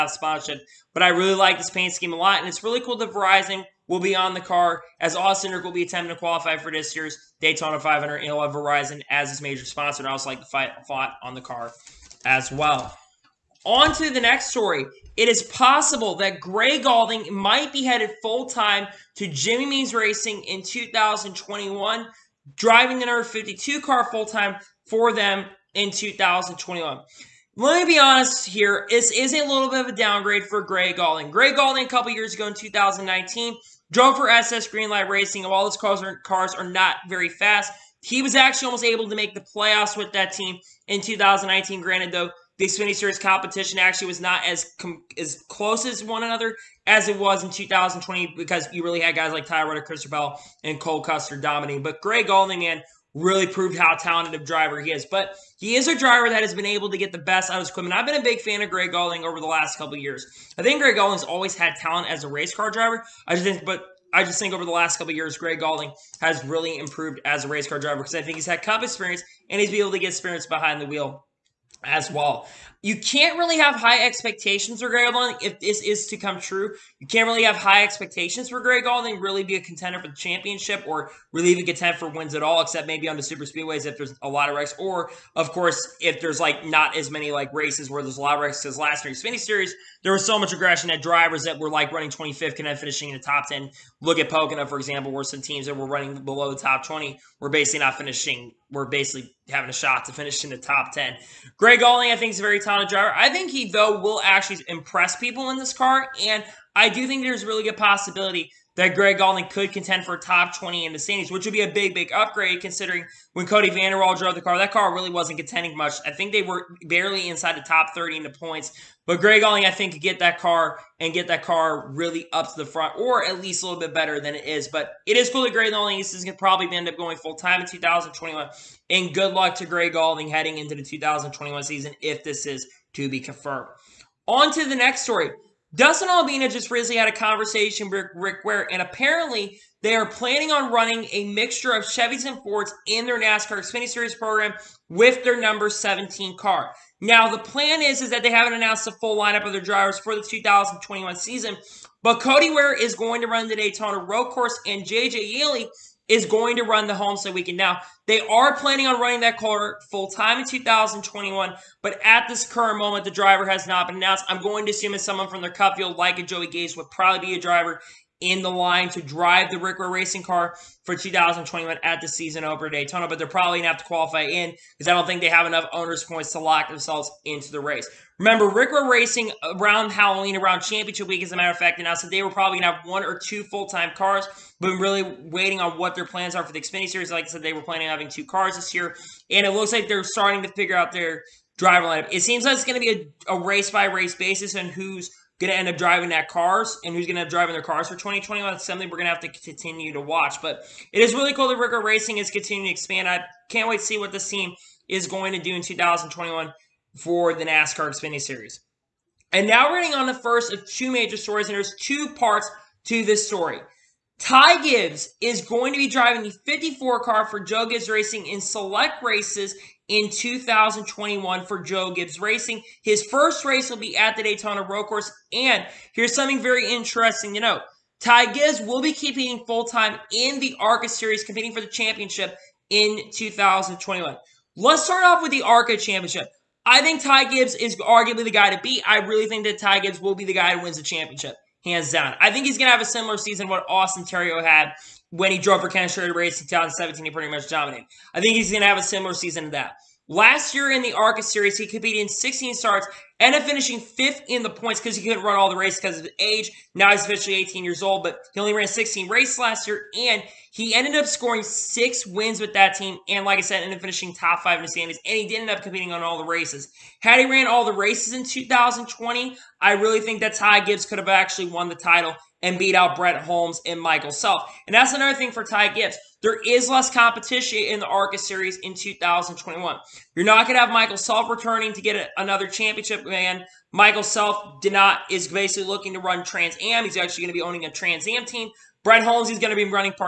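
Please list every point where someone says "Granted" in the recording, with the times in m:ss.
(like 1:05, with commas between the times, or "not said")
0:41.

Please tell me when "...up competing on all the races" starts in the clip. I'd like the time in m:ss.
4:25.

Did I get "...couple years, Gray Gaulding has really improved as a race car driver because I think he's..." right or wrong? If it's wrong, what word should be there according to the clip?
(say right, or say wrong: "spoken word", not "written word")
right.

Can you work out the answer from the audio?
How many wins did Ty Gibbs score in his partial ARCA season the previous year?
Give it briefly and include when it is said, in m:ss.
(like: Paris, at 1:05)
6, at 4:21.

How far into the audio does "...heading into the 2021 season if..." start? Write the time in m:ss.
2:10.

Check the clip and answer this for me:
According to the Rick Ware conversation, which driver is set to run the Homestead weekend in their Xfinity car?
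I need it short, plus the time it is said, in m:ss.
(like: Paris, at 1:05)
JJ Yeley, at 2:34.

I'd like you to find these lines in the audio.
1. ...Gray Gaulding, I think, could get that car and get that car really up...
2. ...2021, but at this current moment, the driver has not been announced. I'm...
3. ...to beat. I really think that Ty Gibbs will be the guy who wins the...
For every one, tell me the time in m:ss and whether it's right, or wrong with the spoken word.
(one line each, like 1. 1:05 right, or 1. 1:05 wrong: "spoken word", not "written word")
1. 1:59 right
2. 2:40 right
3. 3:58 right.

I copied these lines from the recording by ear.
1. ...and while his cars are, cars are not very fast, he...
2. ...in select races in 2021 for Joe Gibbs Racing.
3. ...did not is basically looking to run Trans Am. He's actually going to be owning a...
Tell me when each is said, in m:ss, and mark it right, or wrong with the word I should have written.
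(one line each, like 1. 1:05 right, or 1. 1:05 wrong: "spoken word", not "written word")
1. 0:35 right
2. 3:38 right
3. 4:44 right.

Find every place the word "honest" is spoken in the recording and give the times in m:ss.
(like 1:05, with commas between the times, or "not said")
0:27.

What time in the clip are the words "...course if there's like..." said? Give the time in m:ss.
1:25.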